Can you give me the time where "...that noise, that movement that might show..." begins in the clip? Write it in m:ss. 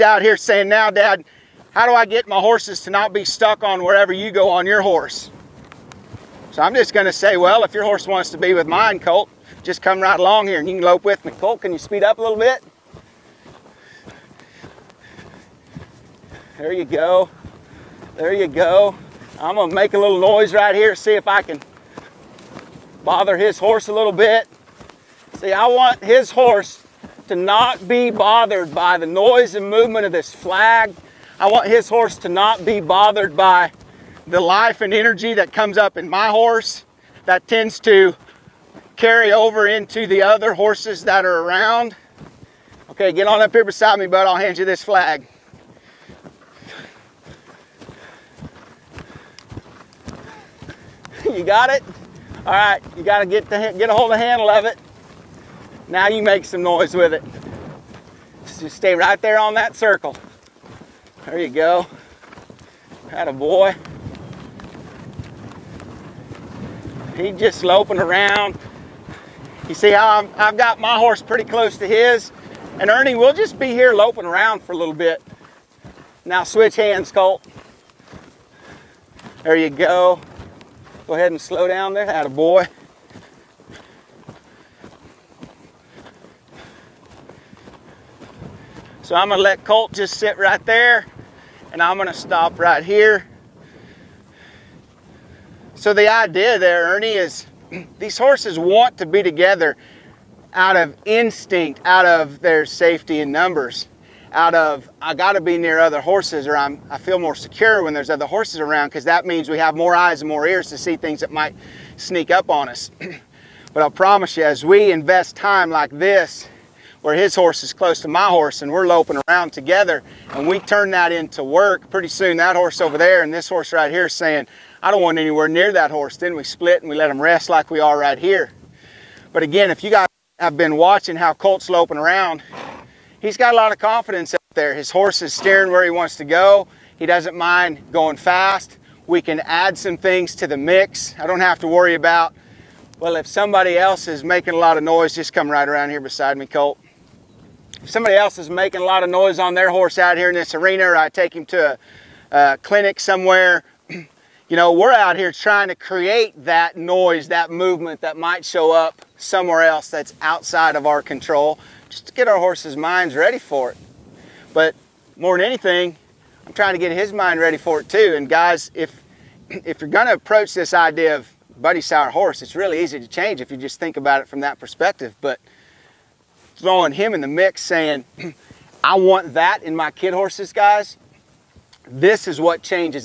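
2:36.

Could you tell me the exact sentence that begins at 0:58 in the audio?
Just stay right there on that circle.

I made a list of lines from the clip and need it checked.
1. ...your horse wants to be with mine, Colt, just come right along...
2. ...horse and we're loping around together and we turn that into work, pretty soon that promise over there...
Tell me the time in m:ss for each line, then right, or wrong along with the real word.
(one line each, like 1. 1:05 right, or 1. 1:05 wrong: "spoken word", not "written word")
1. 0:07 right
2. 1:58 wrong: "horse", not "promise".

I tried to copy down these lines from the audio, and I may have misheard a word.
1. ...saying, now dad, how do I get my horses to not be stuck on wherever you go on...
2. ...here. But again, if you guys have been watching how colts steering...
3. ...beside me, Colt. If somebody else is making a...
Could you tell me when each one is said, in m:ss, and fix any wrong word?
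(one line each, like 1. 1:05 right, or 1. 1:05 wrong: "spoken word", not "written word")
1. 0:00 right
2. 2:08 wrong: "loping", not "steering"
3. 2:26 right.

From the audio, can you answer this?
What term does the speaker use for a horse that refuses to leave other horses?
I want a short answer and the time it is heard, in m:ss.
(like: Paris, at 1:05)
buddy sour, at 2:51.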